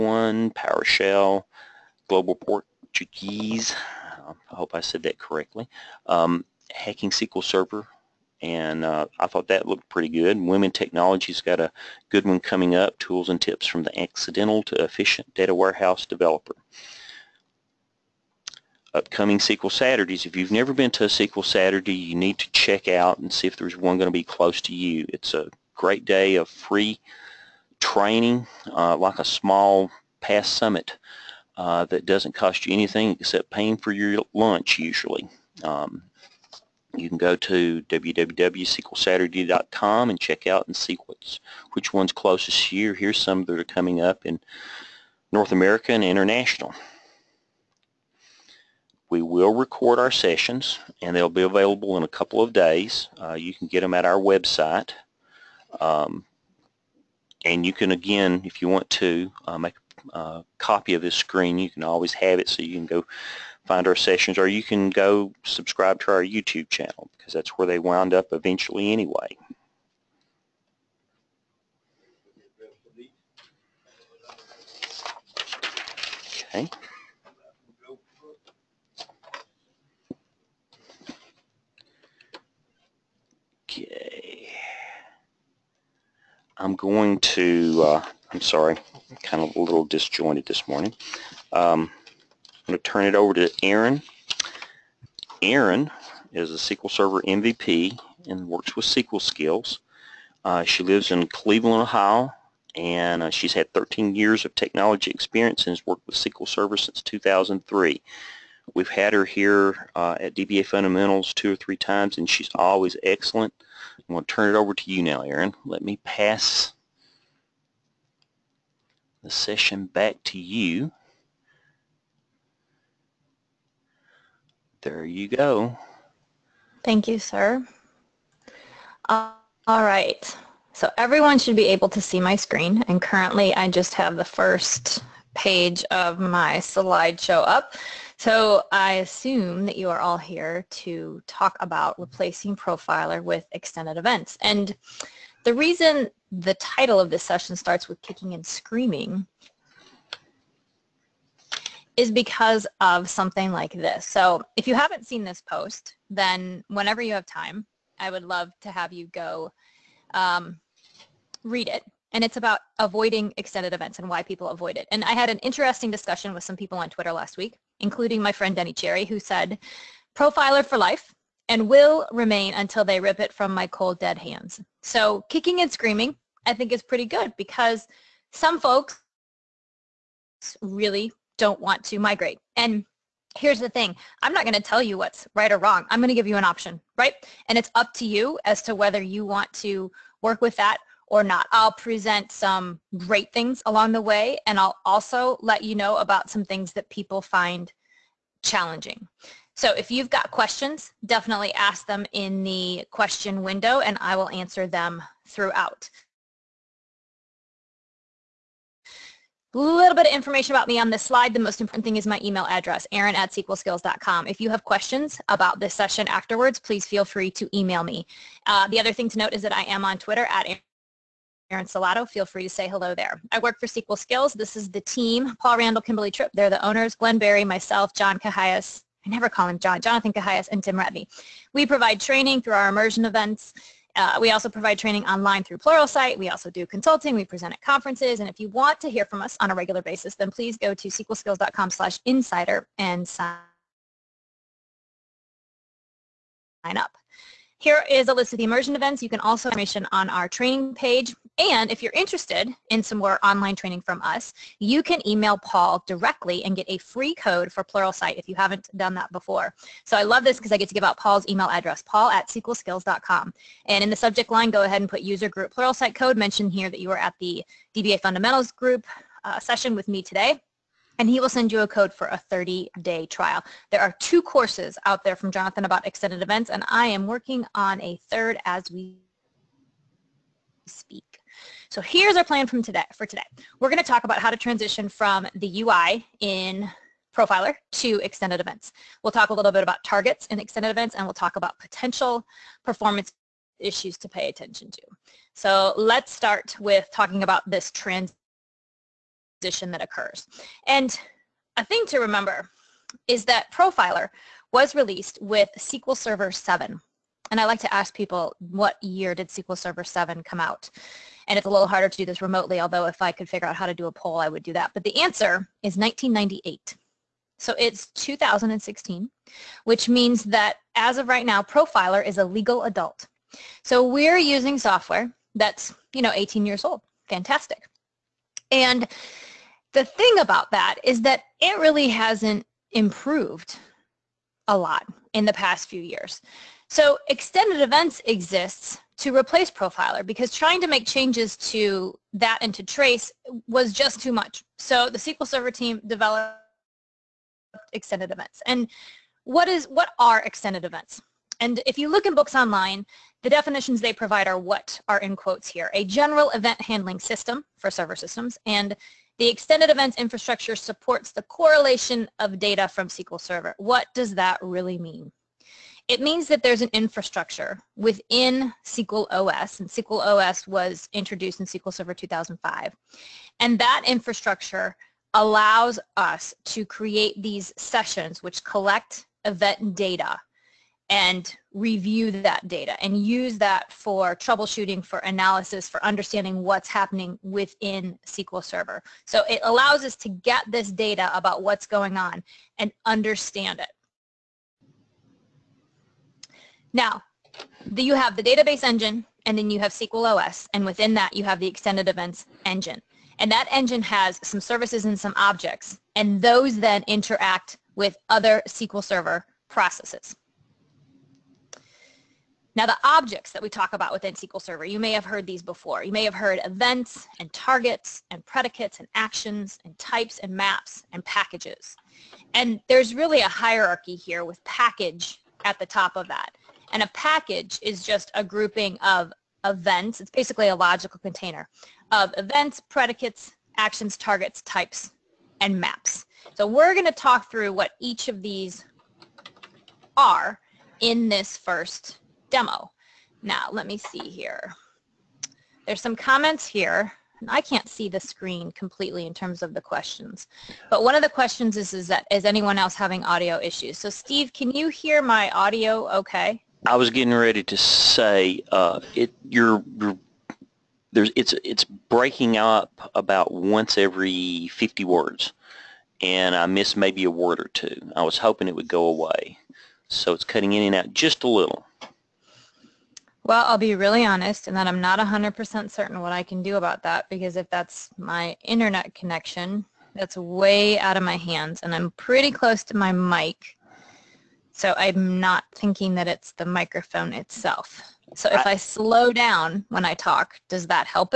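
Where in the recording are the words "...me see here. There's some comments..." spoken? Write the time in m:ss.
7:23.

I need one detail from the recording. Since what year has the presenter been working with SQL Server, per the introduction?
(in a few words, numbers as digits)
2003.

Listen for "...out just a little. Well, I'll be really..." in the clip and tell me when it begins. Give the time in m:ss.
7:50.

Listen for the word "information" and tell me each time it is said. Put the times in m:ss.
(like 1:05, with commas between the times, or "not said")
3:30, 4:09.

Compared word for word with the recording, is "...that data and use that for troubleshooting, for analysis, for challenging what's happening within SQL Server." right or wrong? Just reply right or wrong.
wrong.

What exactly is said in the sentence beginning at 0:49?
We will record our sessions and they'll be available in a couple of days.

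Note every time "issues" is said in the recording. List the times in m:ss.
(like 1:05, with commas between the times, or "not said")
4:53, 7:33.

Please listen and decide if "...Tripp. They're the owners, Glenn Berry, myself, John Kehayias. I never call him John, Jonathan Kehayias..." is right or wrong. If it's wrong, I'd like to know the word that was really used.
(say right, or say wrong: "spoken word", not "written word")
right.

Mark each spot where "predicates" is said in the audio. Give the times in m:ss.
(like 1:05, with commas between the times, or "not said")
6:58, 7:12.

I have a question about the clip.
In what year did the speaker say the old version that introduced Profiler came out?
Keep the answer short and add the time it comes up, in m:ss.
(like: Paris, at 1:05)
1998, at 5:15.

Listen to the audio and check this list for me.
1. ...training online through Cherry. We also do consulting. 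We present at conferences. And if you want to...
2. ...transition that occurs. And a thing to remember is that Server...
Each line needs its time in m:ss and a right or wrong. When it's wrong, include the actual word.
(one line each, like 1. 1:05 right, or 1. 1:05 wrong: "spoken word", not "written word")
1. 3:54 wrong: "Pluralsight", not "Cherry"
2. 4:59 wrong: "Profiler", not "Server".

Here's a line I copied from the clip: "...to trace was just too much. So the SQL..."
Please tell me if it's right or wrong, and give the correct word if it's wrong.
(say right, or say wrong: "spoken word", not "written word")
right.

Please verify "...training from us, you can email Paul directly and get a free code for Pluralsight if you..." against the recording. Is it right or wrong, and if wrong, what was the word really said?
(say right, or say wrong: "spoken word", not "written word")
right.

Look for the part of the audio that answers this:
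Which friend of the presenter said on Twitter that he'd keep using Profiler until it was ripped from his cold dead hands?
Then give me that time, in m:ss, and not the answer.
2:48.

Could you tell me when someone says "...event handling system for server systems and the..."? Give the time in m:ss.
5:56.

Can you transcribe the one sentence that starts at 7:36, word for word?
I was getting ready to say uh, it.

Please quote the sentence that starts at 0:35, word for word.
Um, you can go to www.sqlsaturday.com and check out and see what's, which one's closest to you.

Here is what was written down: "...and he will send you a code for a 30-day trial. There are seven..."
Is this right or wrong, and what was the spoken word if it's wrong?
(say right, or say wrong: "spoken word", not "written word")
wrong: "two", not "seven".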